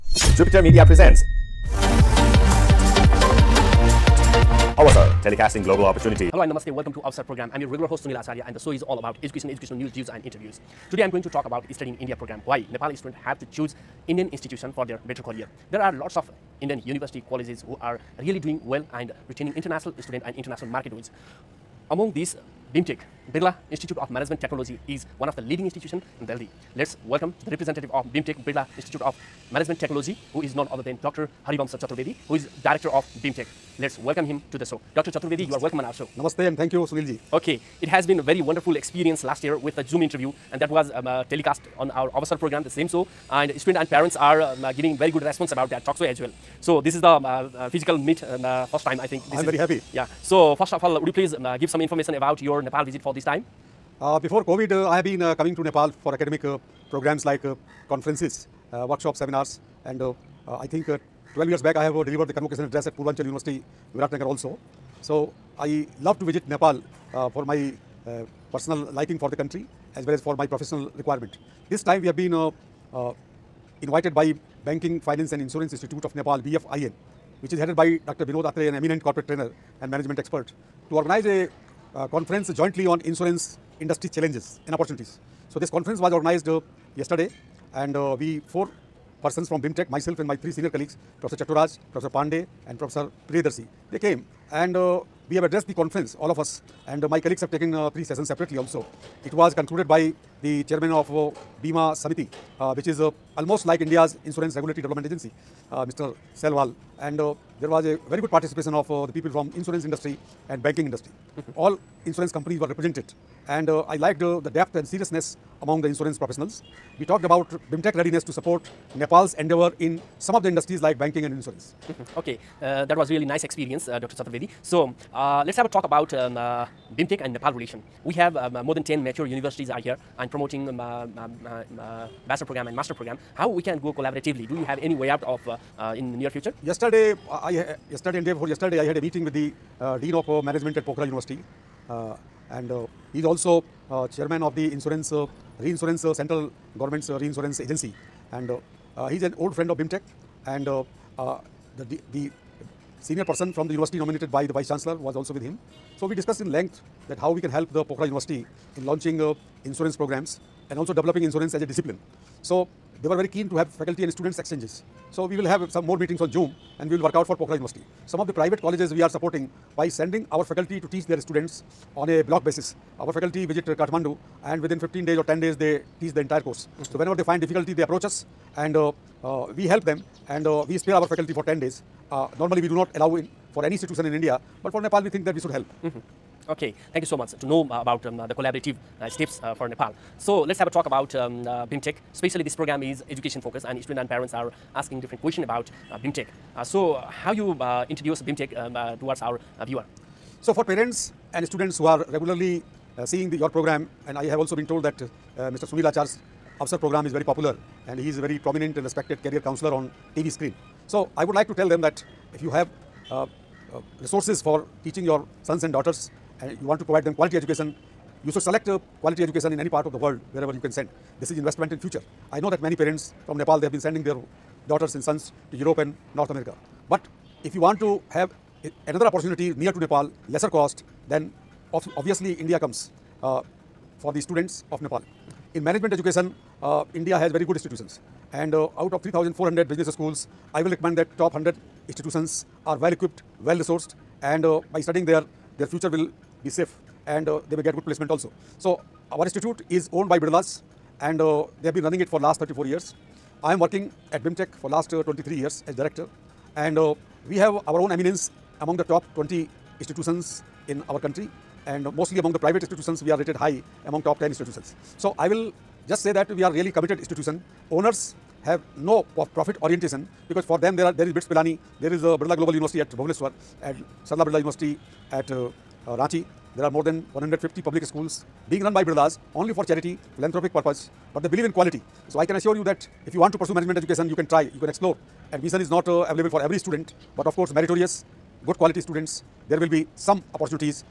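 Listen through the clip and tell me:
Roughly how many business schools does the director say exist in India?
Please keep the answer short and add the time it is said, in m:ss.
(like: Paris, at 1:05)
3,400, at 3:59.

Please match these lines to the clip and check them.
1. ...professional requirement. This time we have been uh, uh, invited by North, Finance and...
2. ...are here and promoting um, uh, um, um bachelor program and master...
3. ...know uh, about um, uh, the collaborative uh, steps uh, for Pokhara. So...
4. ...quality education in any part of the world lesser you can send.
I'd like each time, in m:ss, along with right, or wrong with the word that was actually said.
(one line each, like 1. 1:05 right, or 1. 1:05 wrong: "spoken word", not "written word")
1. 1:10 wrong: "Banking", not "North"
2. 2:09 right
3. 3:07 wrong: "Nepal", not "Pokhara"
4. 3:39 wrong: "wherever", not "lesser".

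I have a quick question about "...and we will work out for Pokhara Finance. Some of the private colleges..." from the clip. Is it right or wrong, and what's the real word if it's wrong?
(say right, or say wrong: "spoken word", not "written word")
wrong: "University", not "Finance".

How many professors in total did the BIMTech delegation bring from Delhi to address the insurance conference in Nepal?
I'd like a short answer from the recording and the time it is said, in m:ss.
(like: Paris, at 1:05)
4, at 1:28.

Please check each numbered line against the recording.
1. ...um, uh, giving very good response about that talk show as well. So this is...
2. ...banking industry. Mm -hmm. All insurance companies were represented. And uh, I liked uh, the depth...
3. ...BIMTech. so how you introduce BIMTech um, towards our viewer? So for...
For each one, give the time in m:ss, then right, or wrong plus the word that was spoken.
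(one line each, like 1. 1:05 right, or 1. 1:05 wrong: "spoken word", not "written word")
1. 0:44 right
2. 1:50 right
3. 3:16 right.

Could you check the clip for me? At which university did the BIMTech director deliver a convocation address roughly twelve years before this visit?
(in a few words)
Purvanchal University.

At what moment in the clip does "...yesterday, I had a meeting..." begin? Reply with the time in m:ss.
2:18.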